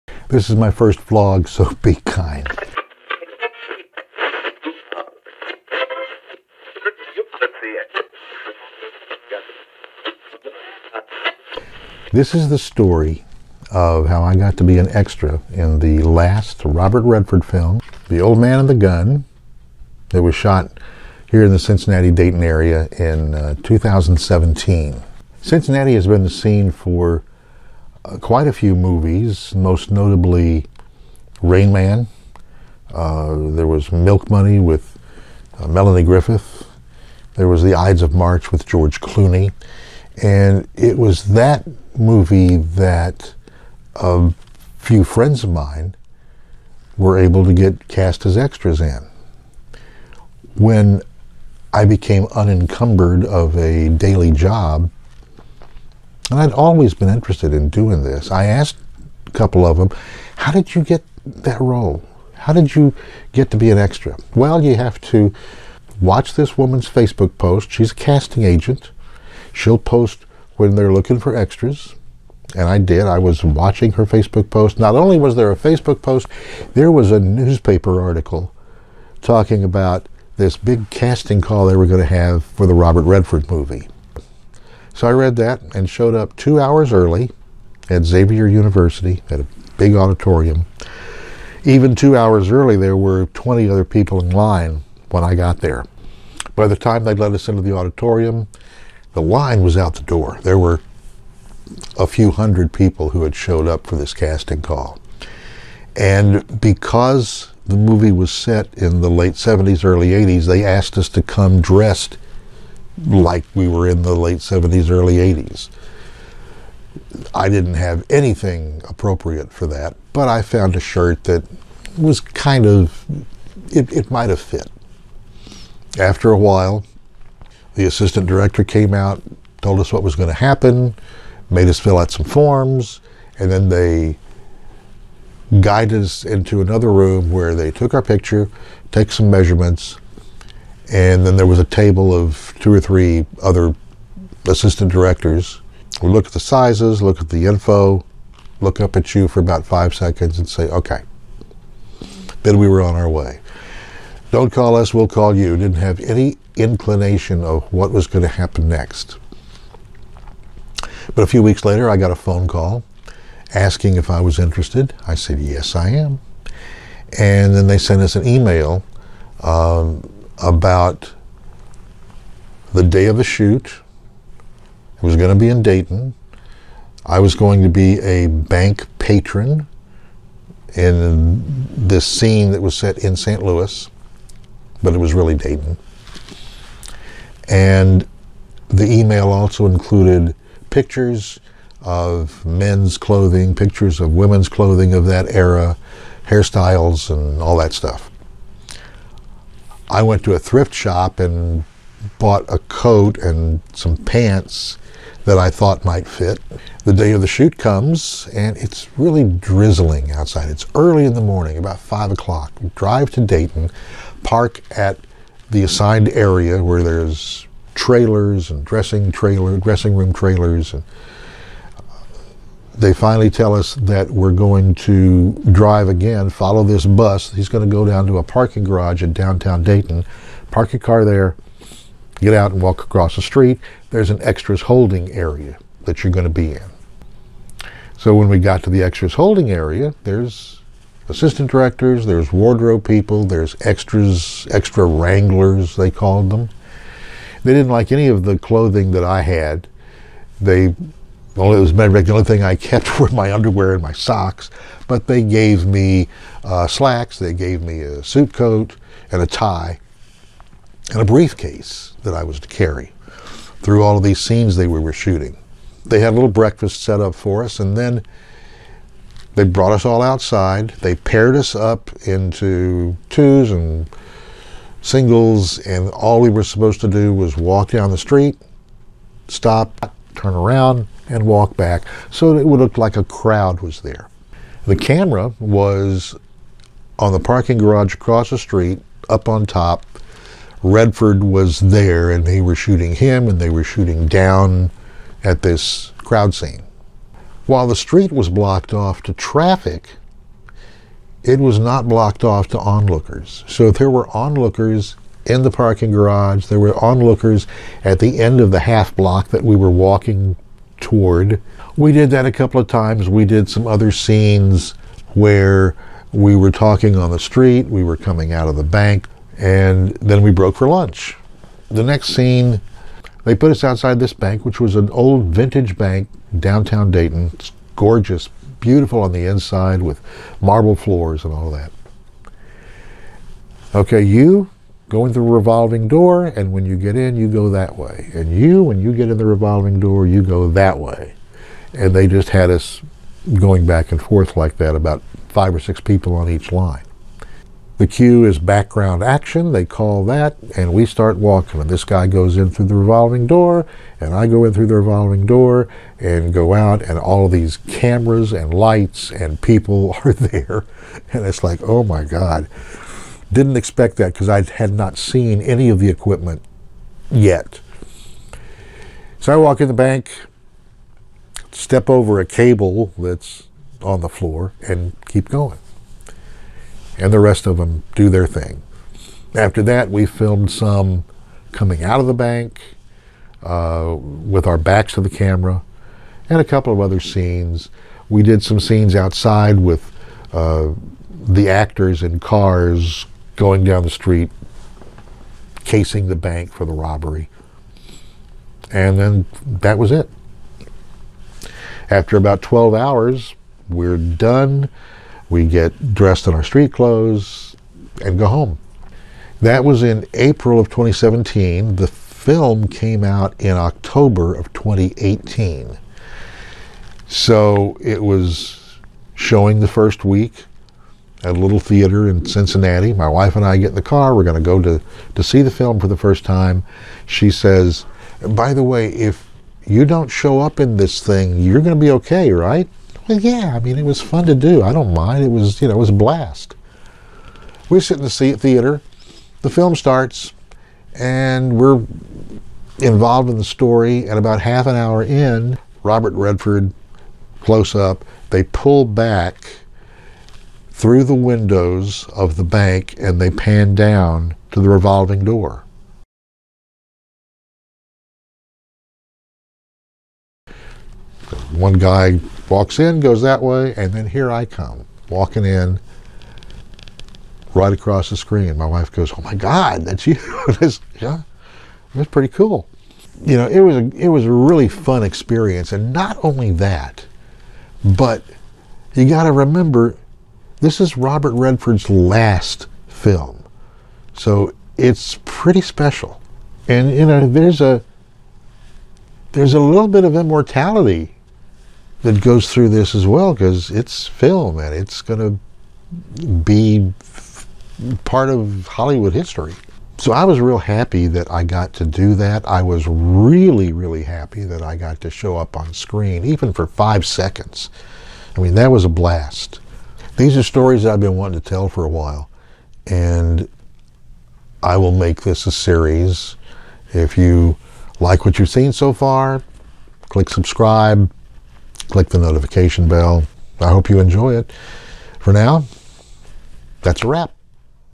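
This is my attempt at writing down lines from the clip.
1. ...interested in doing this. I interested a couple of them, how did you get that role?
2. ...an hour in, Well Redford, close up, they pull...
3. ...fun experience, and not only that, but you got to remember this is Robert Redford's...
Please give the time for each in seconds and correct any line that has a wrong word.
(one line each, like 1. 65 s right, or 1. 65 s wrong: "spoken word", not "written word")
1. 57 s wrong: "asked", not "interested"
2. 444 s wrong: "Robert", not "Well"
3. 474 s right.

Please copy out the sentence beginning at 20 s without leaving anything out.
It was shot here in the Cincinnati Dayton area in uh, 2017.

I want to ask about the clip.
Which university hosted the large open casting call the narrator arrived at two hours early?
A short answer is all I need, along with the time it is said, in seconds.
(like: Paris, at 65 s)
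Xavier University, at 88 s.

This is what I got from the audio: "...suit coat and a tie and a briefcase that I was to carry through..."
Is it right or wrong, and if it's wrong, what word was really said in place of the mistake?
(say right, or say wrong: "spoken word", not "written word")
right.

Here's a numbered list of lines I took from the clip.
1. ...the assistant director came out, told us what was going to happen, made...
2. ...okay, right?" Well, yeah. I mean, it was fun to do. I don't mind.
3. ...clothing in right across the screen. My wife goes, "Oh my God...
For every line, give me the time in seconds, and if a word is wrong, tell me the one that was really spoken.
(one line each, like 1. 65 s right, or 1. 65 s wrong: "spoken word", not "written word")
1. 127 s right
2. 431 s right
3. 465 s wrong: "walking", not "clothing".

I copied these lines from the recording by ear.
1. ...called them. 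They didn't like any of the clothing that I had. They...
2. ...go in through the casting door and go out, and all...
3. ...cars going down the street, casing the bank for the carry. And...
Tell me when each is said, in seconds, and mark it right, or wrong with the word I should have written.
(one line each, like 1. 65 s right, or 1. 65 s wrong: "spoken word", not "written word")
1. 245 s right
2. 354 s wrong: "revolving", not "casting"
3. 392 s wrong: "robbery", not "carry".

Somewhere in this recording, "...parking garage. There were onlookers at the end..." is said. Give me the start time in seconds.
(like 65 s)
305 s.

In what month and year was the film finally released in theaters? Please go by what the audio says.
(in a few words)
October 2018.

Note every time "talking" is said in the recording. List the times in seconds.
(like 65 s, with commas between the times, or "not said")
79 s, 316 s.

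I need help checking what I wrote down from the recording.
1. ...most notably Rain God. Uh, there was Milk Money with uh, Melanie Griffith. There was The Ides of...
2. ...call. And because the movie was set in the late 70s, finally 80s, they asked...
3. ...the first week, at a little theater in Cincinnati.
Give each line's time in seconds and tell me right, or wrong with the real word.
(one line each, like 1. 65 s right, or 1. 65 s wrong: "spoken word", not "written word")
1. 29 s wrong: "Man", not "God"
2. 104 s wrong: "early", not "finally"
3. 419 s right.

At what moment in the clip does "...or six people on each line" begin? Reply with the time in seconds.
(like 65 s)
345 s.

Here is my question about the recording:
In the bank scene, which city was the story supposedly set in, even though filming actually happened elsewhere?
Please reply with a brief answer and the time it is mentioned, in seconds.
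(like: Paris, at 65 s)
St. Louis, at 183 s.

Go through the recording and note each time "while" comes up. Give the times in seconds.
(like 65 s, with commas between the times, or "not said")
126 s, 297 s, 511 s.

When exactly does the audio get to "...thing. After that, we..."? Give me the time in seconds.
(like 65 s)
378 s.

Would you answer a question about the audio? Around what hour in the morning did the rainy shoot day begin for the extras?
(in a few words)
5 o'clock.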